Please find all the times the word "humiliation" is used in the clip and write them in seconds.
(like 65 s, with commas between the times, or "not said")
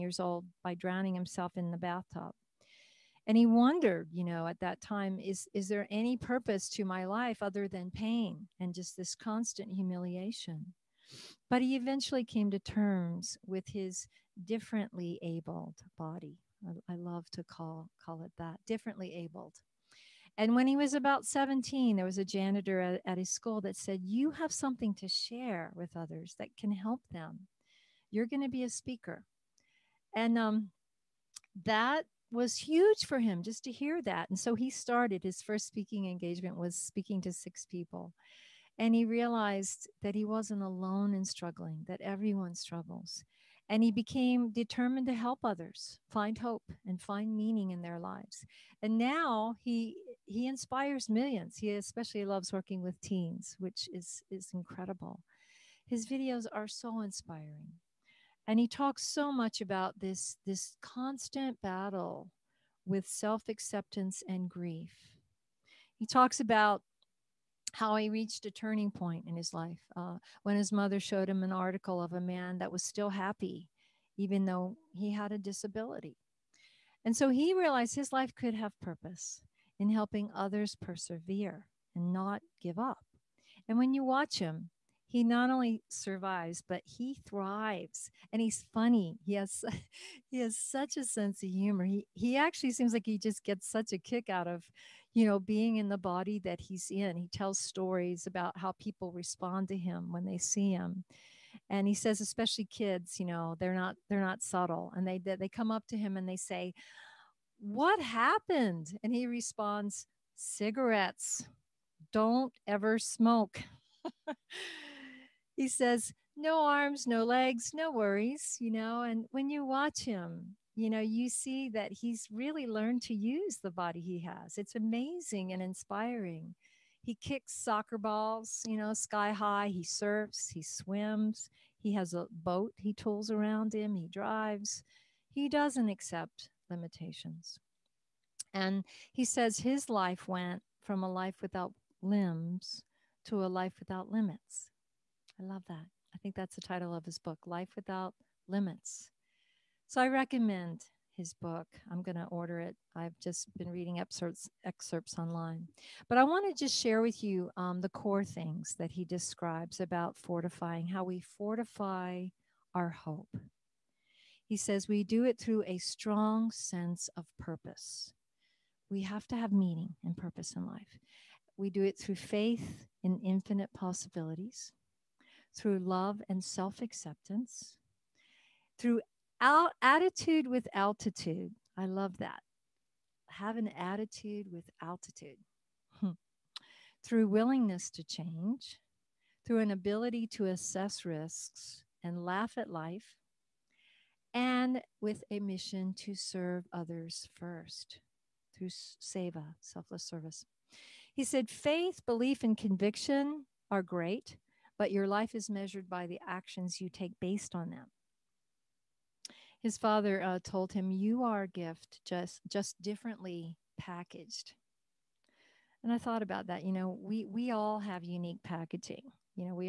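9 s.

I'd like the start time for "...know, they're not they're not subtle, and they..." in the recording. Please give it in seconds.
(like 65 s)
103 s.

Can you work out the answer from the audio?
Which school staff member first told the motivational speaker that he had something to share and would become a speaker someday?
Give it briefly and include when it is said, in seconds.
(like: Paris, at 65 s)
Janitor, at 22 s.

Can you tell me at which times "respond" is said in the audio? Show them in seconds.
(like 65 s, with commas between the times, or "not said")
99 s, 109 s.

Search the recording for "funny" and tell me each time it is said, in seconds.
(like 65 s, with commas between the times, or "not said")
88 s.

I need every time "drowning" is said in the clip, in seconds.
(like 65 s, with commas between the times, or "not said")
0 s.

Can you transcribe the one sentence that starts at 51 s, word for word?
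He especially loves working with teens, which is is incredible.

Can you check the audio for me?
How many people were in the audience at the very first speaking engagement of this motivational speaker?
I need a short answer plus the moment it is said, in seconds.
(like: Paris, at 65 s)
6, at 37 s.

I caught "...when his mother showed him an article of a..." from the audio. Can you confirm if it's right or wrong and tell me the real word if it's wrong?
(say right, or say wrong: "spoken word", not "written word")
right.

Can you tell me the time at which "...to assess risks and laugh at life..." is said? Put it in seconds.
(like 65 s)
190 s.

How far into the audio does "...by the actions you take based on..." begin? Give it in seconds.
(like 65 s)
205 s.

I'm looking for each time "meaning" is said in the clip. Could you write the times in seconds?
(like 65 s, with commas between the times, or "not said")
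47 s, 169 s.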